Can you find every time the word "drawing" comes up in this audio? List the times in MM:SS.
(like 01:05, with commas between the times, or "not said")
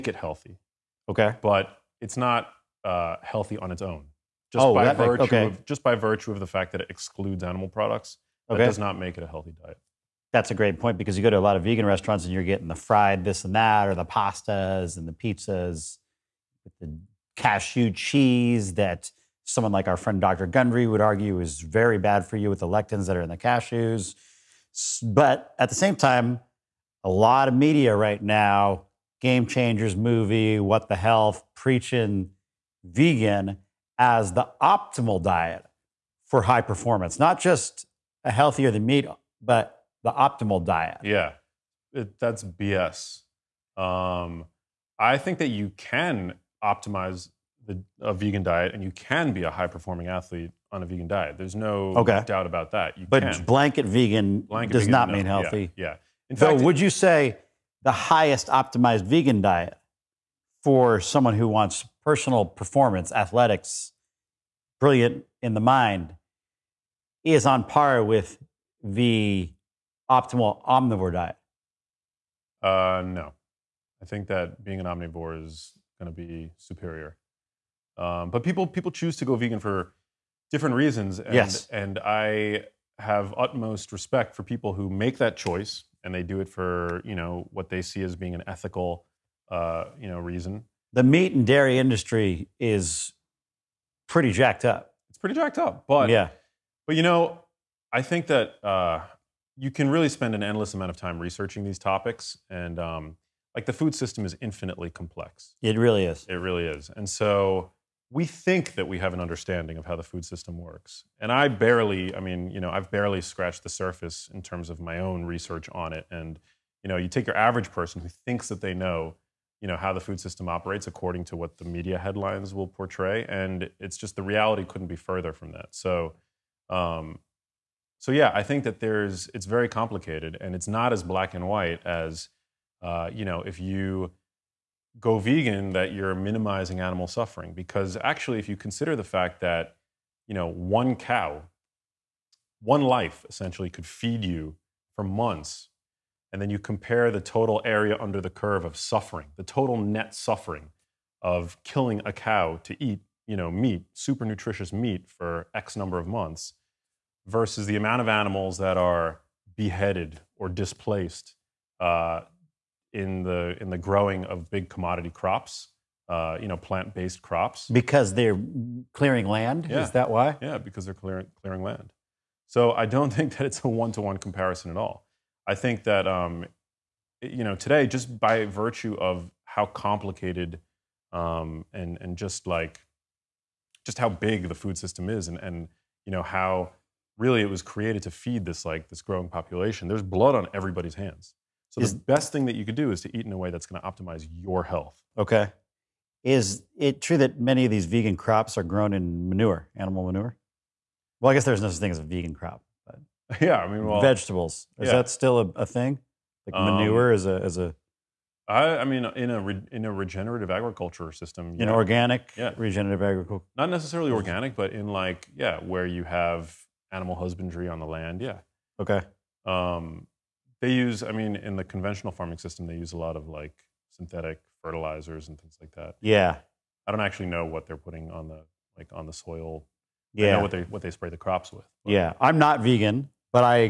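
not said.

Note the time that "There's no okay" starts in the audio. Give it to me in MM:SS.
00:51.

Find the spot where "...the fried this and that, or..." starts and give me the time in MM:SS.
00:12.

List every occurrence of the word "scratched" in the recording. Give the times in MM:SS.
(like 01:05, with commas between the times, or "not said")
01:53.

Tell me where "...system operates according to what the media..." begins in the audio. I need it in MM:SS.
02:00.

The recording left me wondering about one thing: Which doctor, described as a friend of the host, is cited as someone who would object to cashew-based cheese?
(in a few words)
Dr. Gundry.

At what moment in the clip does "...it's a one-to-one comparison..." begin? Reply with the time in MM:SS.
02:53.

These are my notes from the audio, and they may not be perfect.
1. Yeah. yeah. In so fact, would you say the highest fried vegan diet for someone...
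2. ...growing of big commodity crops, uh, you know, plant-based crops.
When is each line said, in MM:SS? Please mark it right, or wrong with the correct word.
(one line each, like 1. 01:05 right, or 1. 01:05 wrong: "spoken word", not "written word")
1. 00:55 wrong: "optimized", not "fried"
2. 02:43 right.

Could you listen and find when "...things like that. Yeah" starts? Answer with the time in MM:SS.
03:45.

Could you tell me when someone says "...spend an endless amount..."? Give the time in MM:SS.
01:40.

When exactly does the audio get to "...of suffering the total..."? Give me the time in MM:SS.
02:28.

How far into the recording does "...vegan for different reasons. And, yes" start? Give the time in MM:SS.
01:19.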